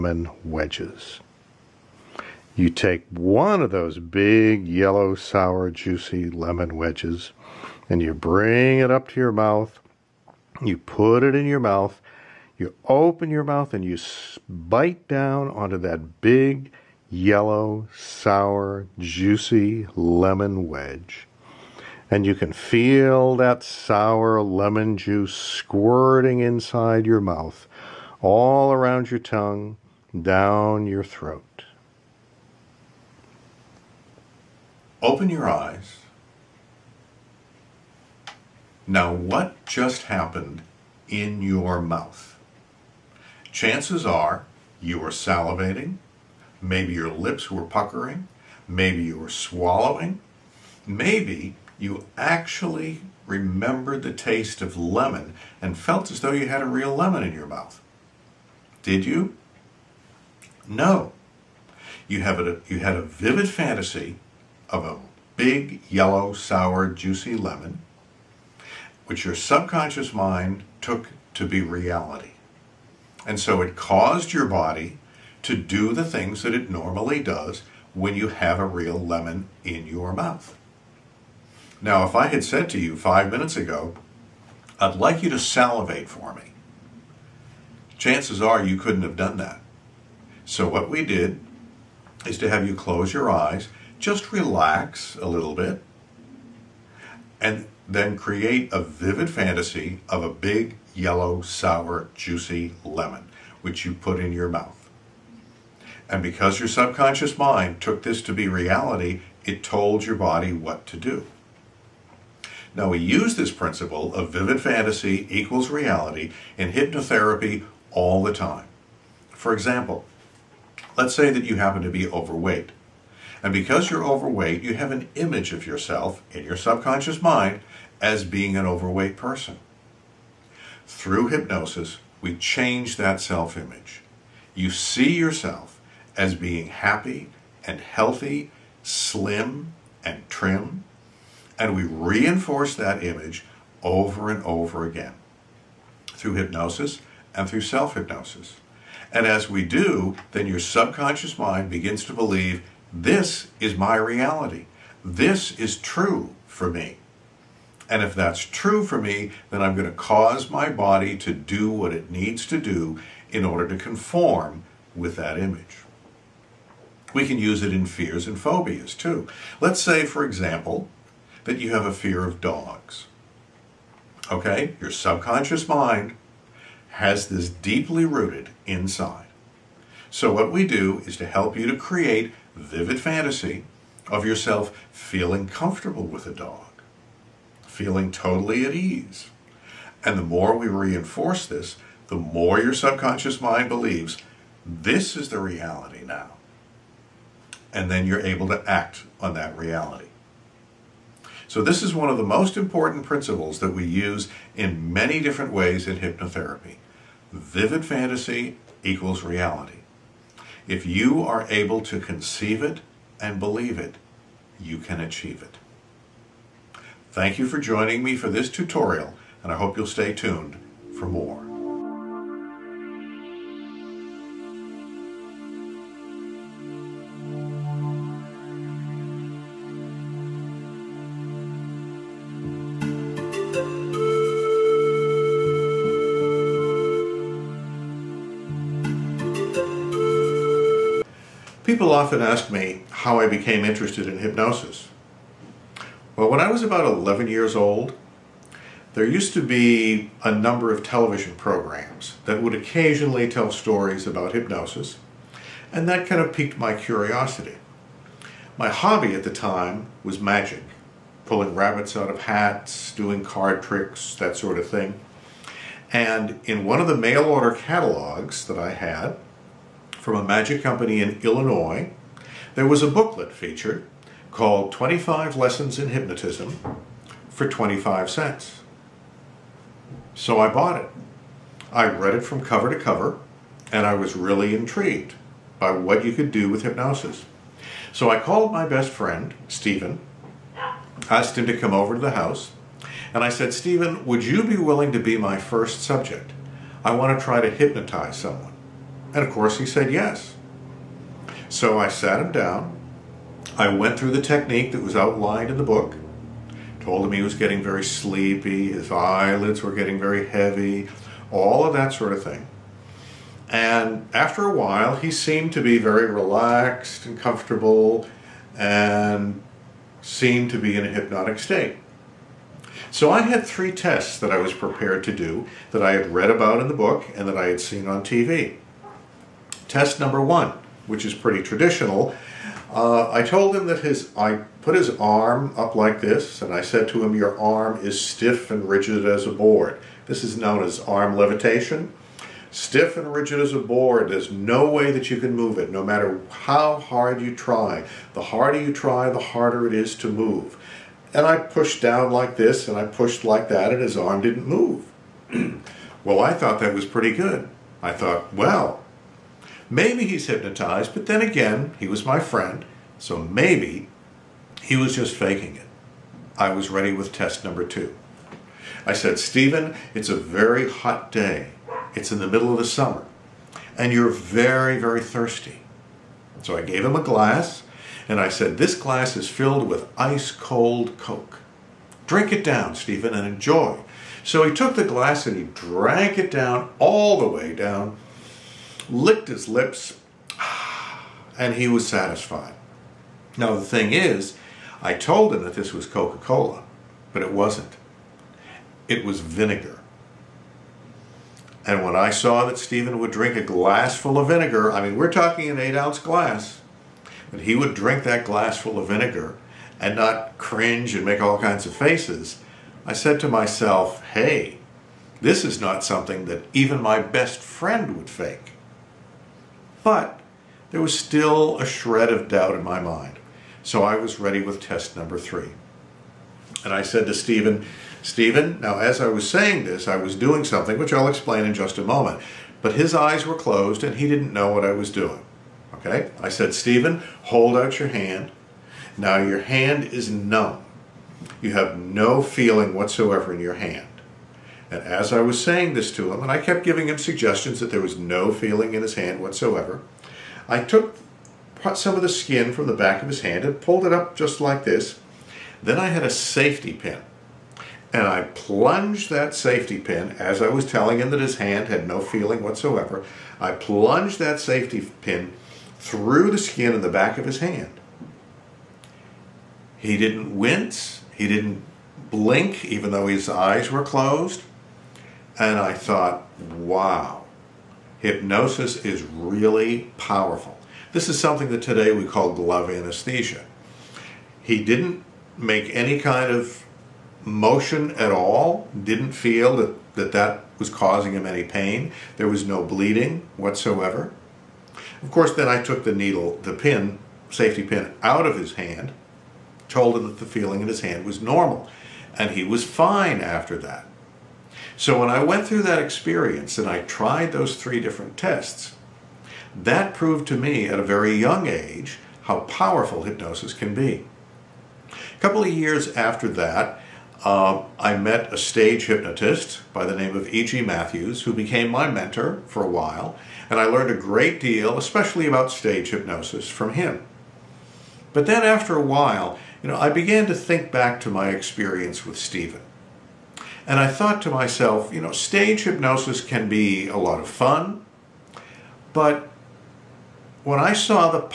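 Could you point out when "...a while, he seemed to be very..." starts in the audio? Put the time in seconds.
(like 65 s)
314 s.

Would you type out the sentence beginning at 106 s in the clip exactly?
And because your subconscious mind took this to be reality, it told your body what to do.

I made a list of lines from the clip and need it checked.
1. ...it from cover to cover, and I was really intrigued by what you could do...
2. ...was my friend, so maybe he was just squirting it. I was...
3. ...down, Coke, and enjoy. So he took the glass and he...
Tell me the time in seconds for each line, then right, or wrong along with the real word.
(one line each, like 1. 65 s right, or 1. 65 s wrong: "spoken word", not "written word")
1. 282 s right
2. 361 s wrong: "faking", not "squirting"
3. 382 s wrong: "Stephen", not "Coke".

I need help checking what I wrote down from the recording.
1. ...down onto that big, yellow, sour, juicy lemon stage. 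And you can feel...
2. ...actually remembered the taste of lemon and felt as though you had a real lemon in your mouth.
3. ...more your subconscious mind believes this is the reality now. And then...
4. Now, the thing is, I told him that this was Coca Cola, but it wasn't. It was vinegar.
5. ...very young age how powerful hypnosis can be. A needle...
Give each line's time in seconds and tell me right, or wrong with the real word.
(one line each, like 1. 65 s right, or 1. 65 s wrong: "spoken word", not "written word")
1. 15 s wrong: "wedge", not "stage"
2. 52 s right
3. 192 s right
4. 393 s right
5. 510 s wrong: "couple", not "needle".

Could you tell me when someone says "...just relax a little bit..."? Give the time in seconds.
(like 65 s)
93 s.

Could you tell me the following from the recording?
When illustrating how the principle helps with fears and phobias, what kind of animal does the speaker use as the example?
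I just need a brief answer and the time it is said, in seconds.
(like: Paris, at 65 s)
Dogs, at 172 s.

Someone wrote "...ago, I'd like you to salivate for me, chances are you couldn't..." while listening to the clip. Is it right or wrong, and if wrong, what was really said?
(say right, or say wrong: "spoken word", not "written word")
right.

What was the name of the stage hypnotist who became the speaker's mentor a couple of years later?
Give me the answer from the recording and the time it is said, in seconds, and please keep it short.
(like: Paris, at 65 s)
E.G. Matthews, at 520 s.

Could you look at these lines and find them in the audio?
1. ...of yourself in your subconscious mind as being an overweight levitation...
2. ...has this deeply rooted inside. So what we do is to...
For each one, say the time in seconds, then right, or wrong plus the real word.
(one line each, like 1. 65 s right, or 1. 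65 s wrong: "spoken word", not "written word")
1. 125 s wrong: "person", not "levitation"
2. 176 s right.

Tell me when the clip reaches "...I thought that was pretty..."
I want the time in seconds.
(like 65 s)
356 s.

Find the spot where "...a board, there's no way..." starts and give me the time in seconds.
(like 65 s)
343 s.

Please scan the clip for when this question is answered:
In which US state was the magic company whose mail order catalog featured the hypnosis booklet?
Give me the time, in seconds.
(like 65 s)
271 s.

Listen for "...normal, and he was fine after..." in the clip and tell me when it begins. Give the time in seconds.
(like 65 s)
501 s.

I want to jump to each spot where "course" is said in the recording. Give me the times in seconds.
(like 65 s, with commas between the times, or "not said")
299 s, 495 s.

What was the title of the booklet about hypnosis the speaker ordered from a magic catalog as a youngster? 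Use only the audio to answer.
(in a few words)
25 Lessons in Hypnotism.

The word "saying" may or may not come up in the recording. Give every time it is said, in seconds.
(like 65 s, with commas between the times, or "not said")
429 s, 445 s.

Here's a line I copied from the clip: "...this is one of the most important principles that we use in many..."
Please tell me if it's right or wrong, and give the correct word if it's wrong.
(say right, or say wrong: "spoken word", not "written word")
right.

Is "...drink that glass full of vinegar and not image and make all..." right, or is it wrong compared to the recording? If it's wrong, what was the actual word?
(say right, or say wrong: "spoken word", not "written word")
wrong: "cringe", not "image".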